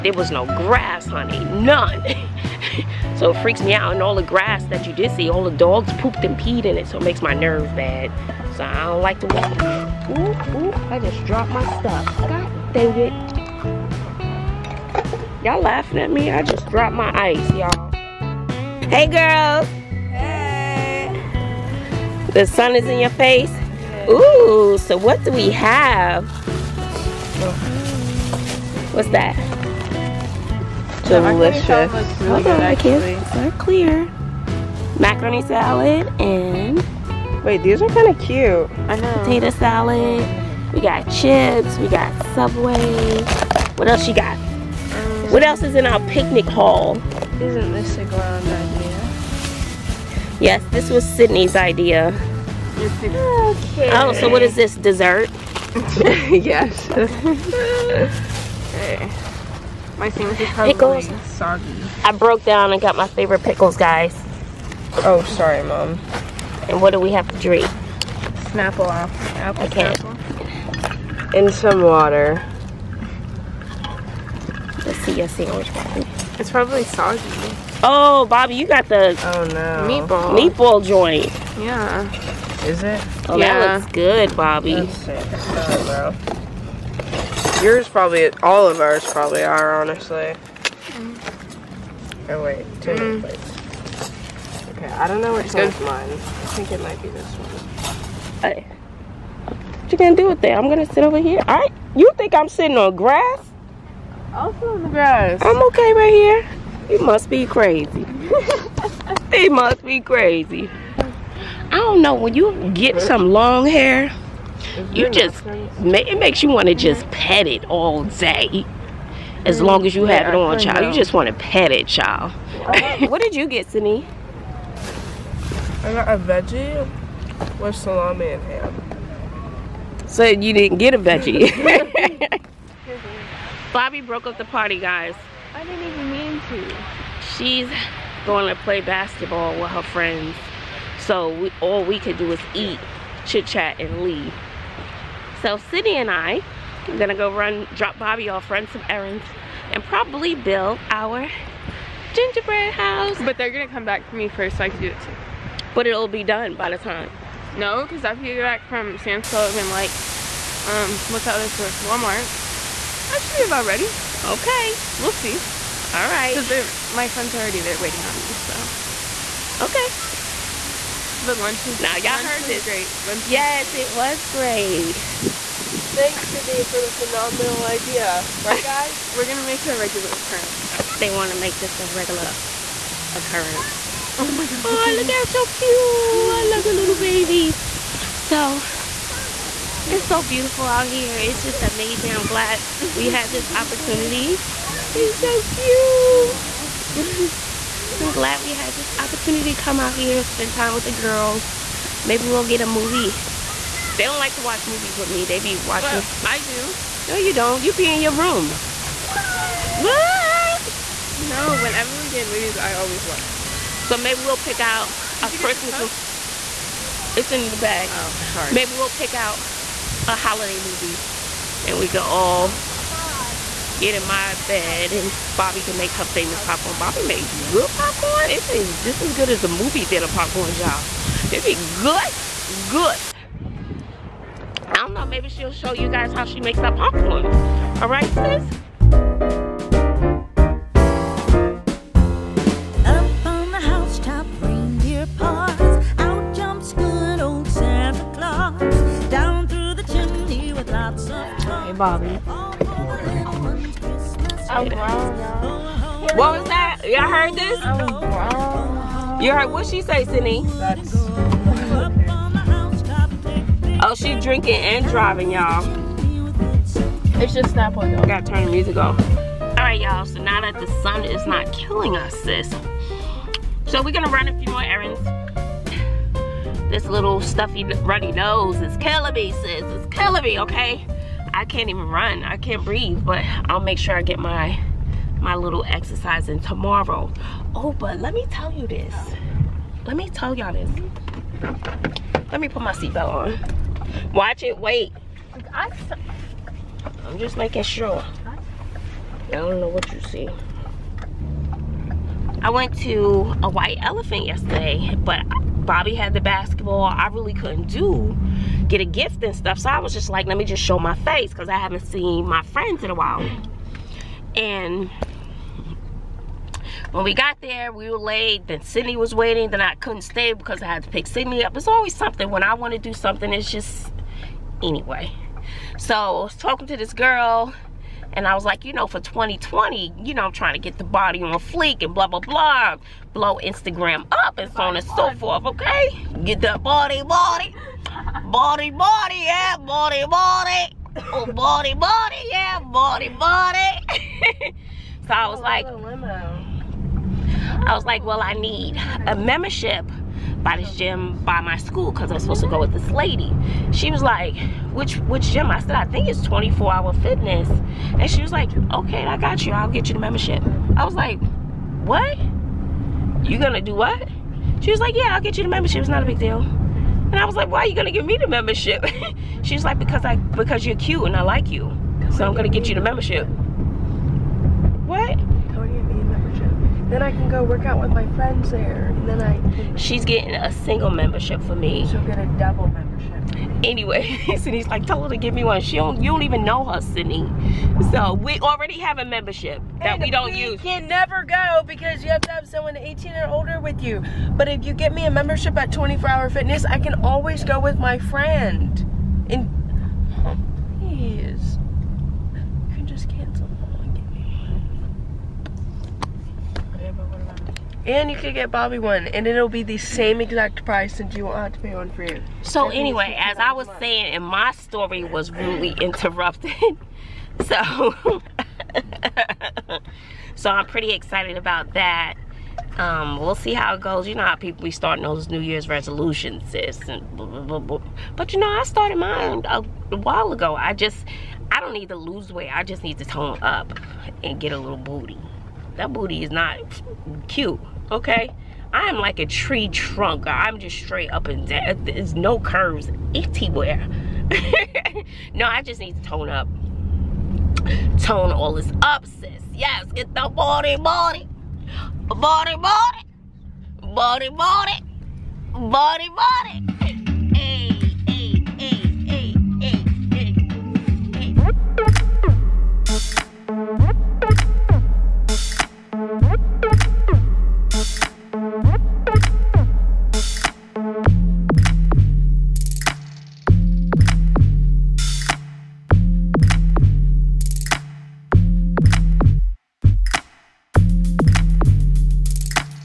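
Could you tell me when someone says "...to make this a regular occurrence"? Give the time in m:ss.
3:01.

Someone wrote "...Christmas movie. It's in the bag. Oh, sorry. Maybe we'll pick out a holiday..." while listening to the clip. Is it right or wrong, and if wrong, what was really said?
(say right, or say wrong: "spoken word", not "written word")
right.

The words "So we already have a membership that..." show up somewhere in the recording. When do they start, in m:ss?
6:27.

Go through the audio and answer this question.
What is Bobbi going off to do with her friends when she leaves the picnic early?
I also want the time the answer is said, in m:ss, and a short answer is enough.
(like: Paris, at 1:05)
Play basketball, at 2:18.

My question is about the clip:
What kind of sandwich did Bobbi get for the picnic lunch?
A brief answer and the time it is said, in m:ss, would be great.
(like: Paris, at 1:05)
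Meatball, at 1:20.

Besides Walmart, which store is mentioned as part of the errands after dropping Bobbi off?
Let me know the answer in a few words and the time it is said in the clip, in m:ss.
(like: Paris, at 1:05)
Sam's Club, at 2:38.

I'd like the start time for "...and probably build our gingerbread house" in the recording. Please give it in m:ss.
2:29.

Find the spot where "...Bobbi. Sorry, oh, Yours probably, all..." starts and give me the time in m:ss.
1:24.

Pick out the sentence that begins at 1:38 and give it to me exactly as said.
Hey, what you gonna do with that?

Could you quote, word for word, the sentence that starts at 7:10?
I just, I don't need to lose weight.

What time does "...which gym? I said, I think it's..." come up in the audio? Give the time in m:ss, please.
5:54.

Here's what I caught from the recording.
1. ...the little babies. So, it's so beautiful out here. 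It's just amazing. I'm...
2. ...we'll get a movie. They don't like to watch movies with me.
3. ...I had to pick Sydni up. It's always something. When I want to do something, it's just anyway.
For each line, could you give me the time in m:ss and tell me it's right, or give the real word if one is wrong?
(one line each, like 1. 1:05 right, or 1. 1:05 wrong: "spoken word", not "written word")
1. 3:06 right
2. 3:22 right
3. 5:20 right.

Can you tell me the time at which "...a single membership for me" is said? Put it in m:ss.
6:20.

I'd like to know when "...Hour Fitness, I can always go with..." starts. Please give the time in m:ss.
6:36.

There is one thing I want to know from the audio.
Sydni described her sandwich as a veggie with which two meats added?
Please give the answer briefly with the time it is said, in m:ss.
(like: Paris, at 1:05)
Salami and ham, at 2:07.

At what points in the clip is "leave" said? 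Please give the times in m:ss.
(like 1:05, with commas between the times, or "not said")
2:24.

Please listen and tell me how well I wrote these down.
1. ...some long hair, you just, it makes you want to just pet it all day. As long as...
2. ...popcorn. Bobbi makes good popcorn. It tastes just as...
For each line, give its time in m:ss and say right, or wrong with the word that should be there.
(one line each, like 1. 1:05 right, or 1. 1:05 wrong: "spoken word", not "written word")
1. 1:53 right
2. 3:46 right.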